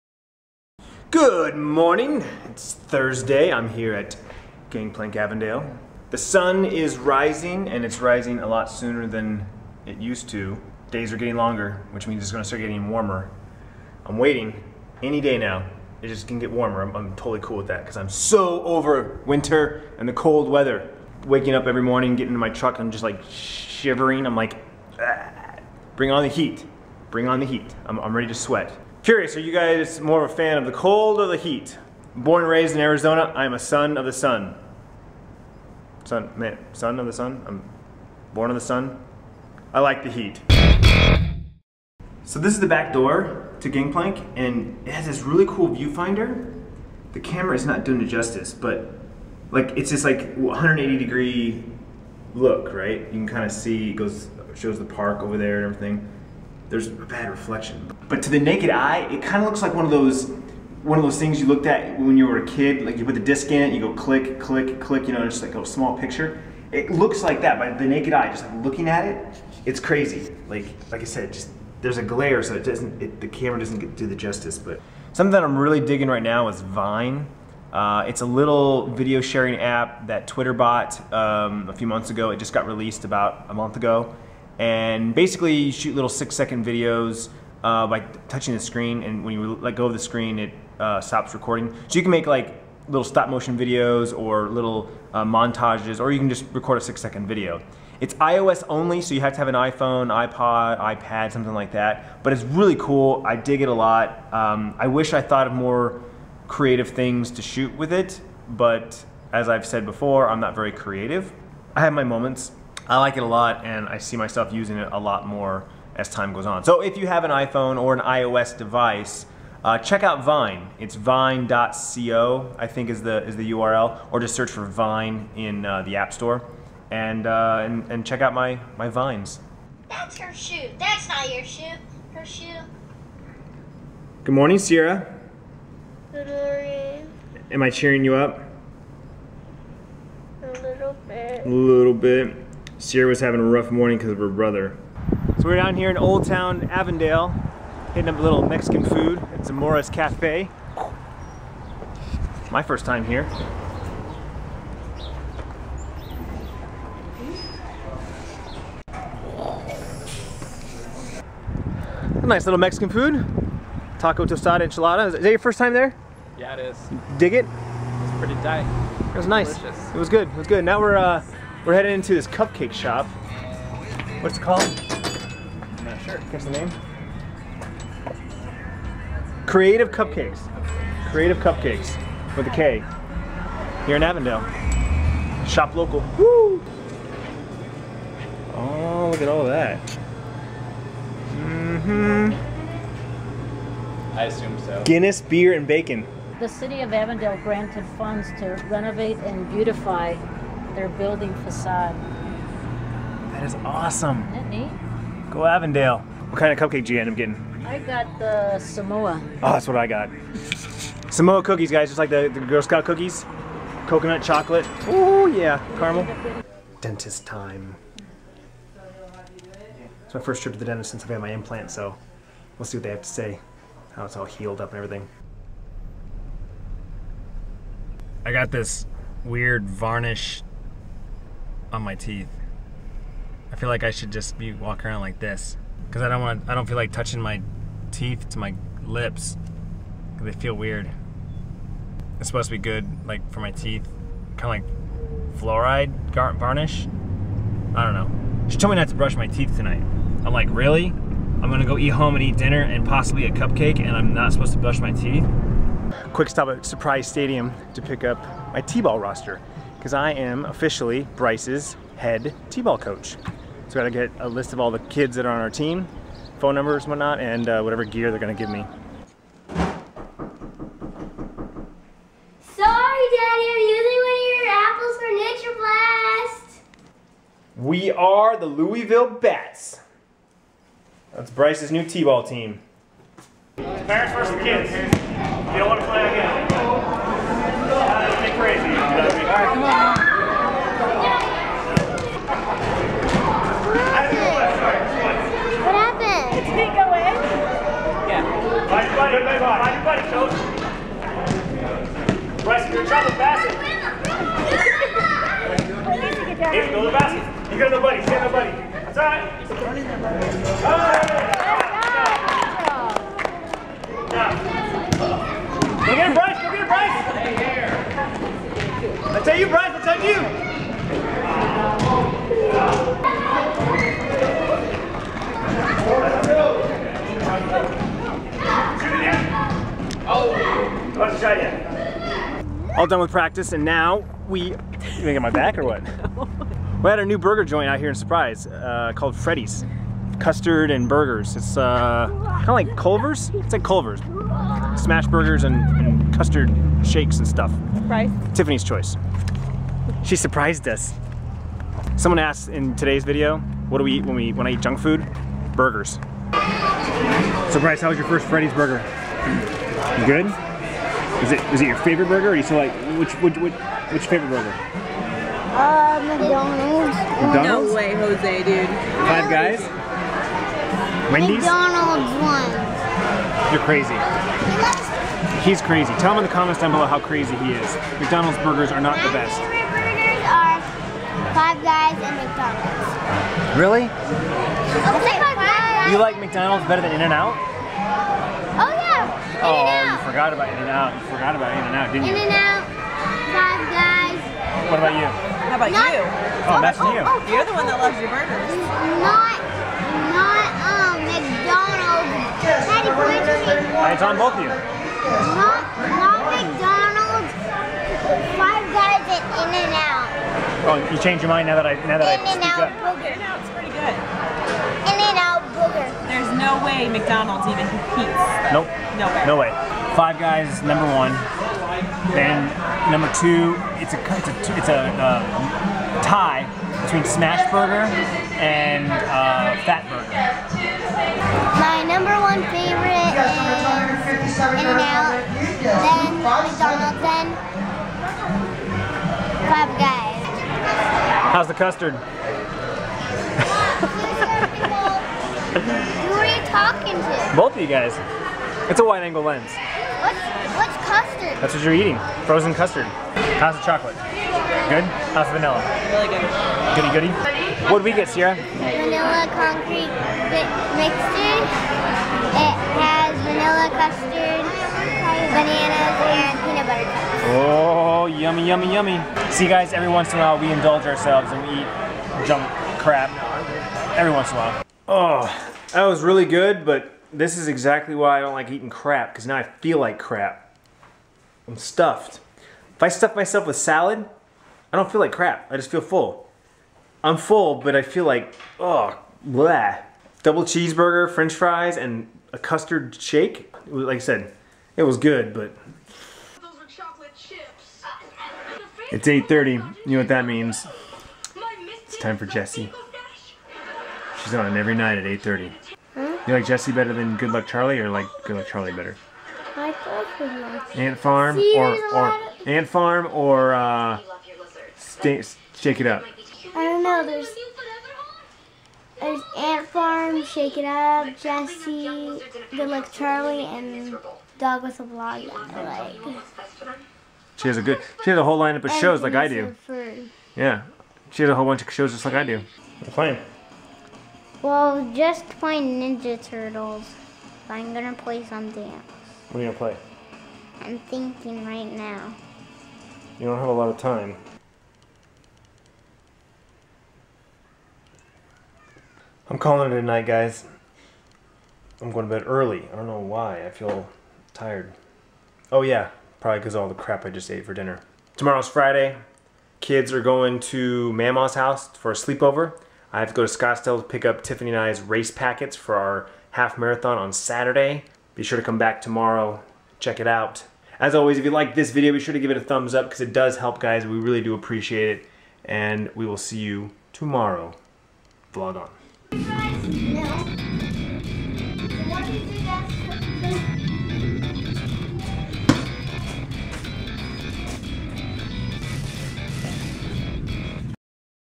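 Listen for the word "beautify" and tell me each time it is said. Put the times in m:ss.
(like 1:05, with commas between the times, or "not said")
3:19.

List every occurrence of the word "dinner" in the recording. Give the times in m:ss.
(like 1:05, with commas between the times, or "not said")
4:12, 9:17.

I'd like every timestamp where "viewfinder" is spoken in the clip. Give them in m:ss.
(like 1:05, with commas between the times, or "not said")
0:45.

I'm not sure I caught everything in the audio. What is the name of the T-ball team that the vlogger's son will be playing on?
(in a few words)
Louisville Bats.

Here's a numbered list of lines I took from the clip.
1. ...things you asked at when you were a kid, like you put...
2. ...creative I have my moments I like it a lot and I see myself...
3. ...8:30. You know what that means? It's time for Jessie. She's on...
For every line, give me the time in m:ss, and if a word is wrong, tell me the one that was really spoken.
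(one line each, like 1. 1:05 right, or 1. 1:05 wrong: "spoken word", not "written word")
1. 1:01 wrong: "looked", not "asked"
2. 1:50 right
3. 8:19 right.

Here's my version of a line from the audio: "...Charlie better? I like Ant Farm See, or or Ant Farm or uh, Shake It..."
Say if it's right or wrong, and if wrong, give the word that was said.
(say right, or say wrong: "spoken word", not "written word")
right.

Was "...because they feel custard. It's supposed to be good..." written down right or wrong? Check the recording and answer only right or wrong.
wrong.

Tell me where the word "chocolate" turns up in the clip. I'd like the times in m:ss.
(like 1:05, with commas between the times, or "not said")
3:34, 7:33.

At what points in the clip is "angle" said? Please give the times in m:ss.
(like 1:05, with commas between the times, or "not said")
7:29.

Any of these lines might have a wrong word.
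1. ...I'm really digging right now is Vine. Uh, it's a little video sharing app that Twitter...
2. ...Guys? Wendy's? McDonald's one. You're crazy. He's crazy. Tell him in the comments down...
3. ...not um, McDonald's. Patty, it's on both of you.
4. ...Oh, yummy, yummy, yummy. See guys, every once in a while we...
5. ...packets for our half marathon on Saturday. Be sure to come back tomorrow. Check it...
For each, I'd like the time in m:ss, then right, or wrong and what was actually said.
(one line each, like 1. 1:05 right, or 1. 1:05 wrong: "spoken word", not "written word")
1. 1:15 right
2. 6:09 right
3. 6:40 right
4. 7:47 right
5. 9:25 right.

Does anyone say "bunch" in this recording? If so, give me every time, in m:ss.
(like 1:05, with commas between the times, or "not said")
8:51.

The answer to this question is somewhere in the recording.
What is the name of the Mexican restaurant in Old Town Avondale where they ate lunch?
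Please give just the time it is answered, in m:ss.
2:29.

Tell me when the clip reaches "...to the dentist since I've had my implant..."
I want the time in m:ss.
3:40.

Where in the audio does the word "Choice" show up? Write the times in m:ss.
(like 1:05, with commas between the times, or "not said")
5:48.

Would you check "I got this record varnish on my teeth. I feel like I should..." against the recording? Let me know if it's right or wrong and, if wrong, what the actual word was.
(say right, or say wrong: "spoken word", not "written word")
wrong: "weird", not "record".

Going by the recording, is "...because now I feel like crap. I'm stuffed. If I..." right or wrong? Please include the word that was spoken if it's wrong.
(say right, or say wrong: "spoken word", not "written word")
right.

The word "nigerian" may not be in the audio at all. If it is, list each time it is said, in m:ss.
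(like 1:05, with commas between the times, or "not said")
not said.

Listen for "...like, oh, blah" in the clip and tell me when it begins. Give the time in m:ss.
8:08.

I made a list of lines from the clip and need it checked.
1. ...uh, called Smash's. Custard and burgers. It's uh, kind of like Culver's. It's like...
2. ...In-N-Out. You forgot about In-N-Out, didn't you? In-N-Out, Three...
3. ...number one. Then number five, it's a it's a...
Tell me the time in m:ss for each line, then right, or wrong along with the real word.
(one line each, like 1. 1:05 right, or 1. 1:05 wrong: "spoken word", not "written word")
1. 5:38 wrong: "Freddy", not "Smash"
2. 6:30 wrong: "Five", not "Three"
3. 7:00 wrong: "two", not "five".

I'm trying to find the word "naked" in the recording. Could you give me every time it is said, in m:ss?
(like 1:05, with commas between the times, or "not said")
0:58, 1:07.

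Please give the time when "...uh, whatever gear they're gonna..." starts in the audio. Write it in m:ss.
4:27.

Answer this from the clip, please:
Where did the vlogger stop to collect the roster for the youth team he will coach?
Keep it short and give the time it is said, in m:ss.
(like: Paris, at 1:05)
Surprise Stadium, at 4:16.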